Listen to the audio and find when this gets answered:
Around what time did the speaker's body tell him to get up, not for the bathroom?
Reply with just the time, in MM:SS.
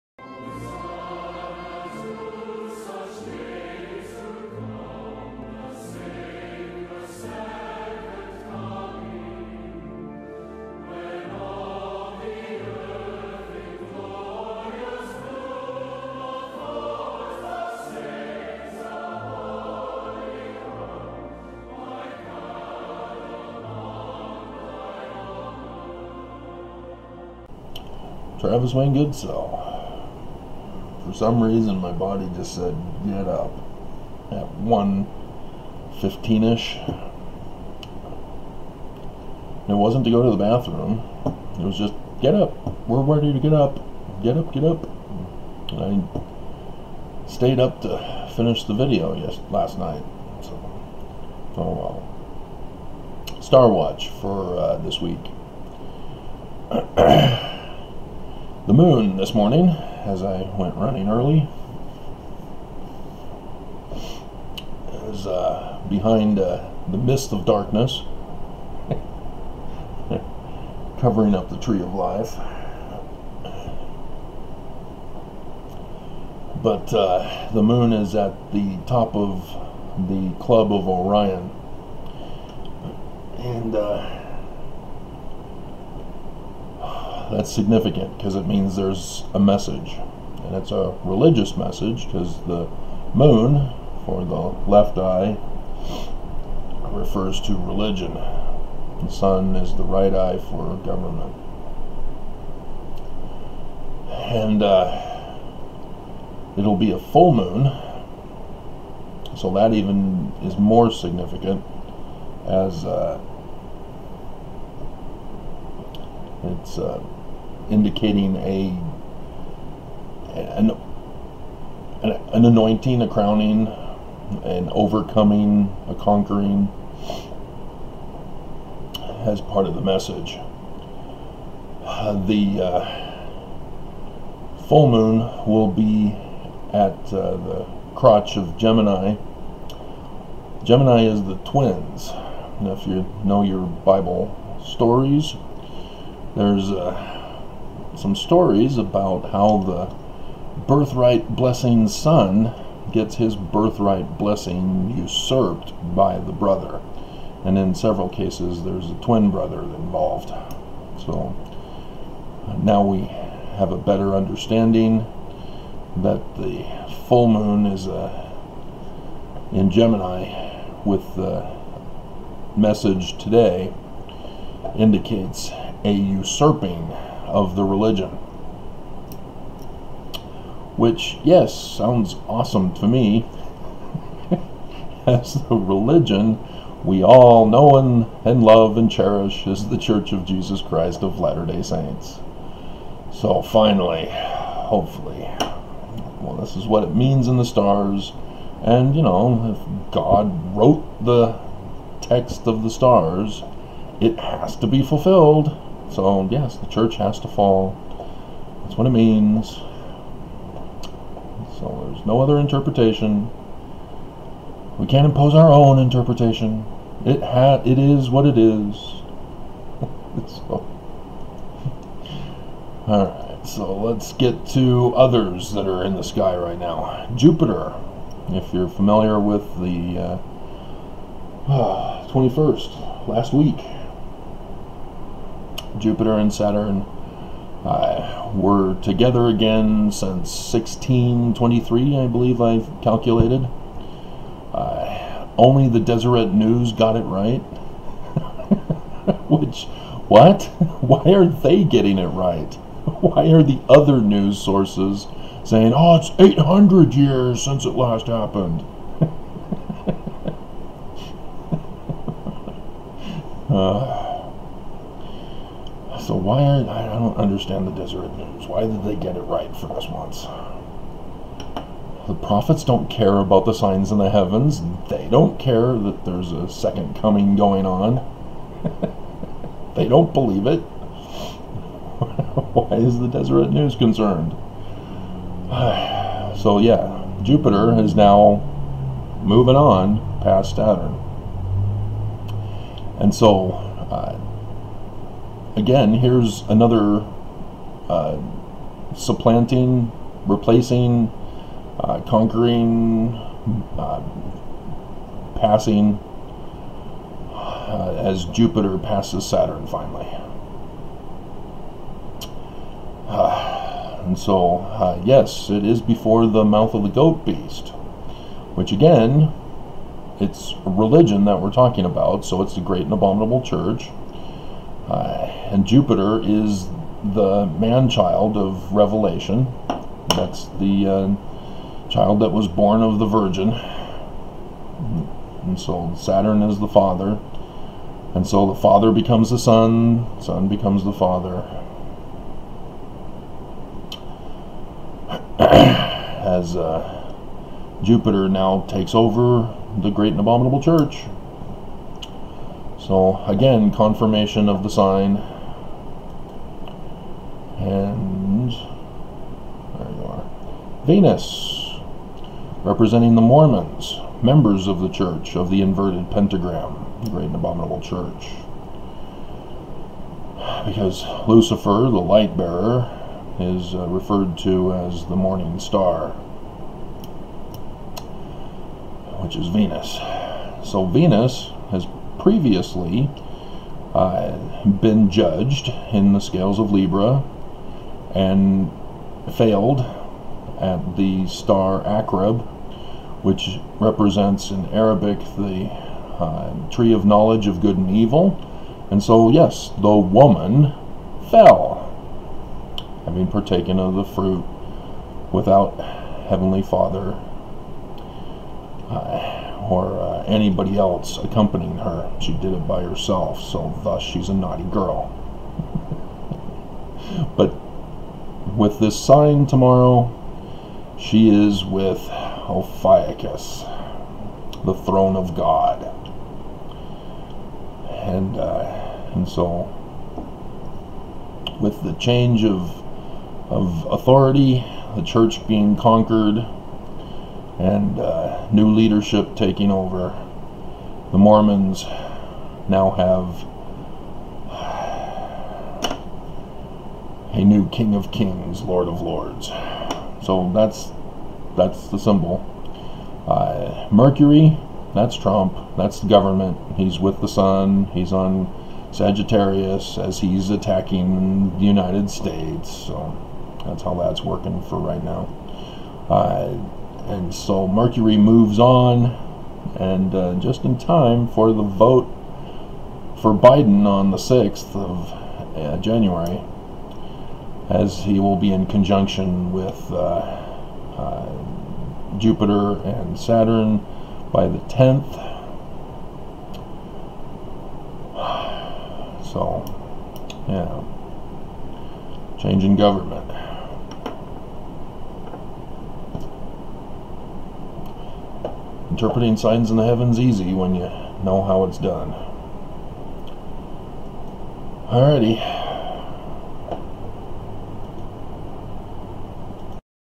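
00:34.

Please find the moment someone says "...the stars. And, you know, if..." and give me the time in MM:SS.
03:17.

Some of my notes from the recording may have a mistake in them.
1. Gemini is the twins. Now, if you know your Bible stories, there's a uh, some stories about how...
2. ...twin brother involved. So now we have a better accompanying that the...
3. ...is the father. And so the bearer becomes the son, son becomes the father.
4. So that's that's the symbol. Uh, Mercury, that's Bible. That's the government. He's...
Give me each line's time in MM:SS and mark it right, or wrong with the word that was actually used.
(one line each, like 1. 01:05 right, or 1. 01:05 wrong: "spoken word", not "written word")
1. 02:20 right
2. 02:39 wrong: "understanding", not "accompanying"
3. 05:36 wrong: "father", not "bearer"
4. 07:30 wrong: "Trump", not "Bible".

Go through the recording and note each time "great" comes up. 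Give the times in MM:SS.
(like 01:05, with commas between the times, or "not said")
05:22, 05:49, 06:07.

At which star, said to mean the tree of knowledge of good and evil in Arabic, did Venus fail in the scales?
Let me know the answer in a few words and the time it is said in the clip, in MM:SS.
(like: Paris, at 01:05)
Akrab, at 06:31.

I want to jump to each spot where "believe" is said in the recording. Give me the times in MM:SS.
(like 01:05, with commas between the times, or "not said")
04:02, 04:40.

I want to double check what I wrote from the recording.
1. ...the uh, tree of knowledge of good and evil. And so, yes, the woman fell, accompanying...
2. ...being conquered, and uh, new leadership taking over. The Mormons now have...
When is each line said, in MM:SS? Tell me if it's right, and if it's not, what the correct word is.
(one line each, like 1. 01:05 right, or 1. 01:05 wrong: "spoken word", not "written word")
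1. 06:35 wrong: "having", not "accompanying"
2. 07:15 right.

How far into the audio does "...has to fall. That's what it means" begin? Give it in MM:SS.
03:26.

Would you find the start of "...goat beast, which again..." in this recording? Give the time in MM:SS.
05:16.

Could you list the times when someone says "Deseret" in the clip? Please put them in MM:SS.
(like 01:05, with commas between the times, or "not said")
04:05, 04:27, 04:43.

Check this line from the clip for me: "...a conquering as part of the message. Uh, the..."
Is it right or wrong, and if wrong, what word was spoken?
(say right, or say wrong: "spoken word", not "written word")
right.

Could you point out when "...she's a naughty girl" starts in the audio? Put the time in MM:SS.
06:54.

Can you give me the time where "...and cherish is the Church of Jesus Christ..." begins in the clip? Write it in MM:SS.
03:08.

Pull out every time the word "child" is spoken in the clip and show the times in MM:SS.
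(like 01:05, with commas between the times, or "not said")
05:27, 05:31.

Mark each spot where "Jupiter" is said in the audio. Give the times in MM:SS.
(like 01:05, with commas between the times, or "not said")
03:47, 03:55, 04:47, 05:08, 05:25, 05:47, 08:02.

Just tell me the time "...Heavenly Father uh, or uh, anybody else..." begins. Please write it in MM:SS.
06:46.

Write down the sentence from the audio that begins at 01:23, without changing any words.
And uh, that's significant because it means there's a message.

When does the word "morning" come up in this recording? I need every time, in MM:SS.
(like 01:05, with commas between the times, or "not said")
00:59, 06:15.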